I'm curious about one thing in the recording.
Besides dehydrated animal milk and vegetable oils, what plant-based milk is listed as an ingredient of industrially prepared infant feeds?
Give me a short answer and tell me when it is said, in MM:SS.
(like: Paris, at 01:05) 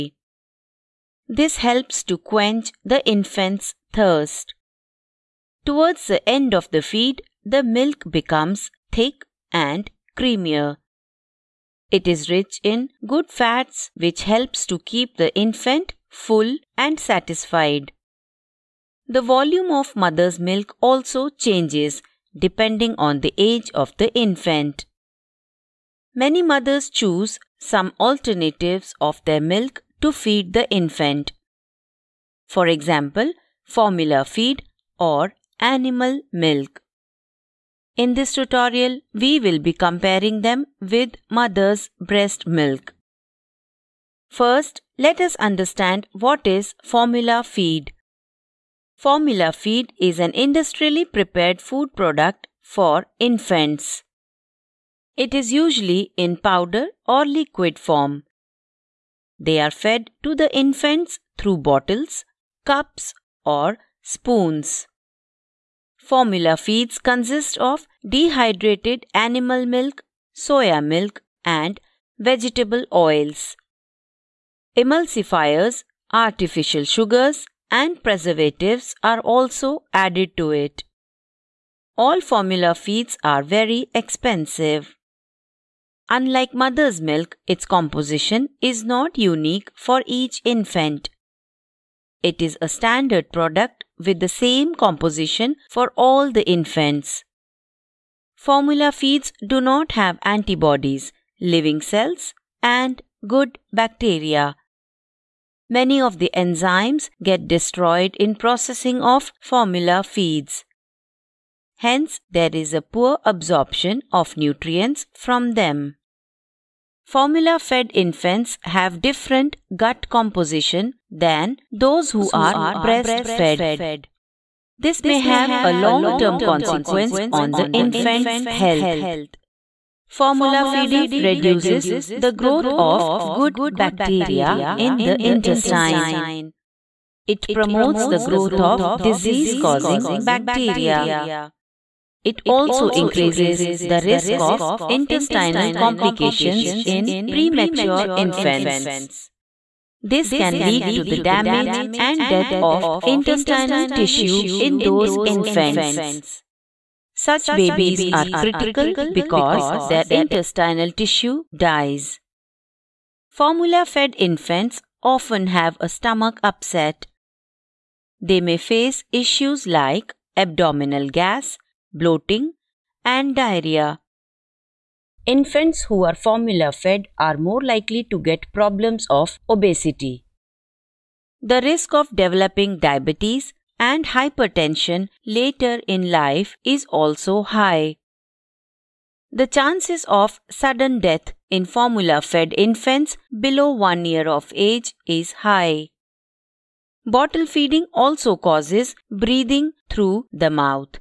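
Soya milk, at 01:10.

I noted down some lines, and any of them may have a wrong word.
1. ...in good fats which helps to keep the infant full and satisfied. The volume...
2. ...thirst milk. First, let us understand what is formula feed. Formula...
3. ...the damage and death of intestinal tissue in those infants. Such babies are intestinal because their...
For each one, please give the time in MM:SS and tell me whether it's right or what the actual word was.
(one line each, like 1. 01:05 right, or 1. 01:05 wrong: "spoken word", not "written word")
1. 00:12 right
2. 00:42 wrong: "breast", not "thirst"
3. 02:31 wrong: "critical", not "intestinal".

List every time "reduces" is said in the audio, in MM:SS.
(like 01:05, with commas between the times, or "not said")
02:11.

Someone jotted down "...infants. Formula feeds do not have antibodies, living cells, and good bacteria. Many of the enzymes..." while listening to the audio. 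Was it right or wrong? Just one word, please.
right.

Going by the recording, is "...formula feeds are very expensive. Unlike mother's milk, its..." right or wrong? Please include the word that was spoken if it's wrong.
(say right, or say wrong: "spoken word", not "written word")
right.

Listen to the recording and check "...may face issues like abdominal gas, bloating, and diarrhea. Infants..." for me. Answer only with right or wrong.
right.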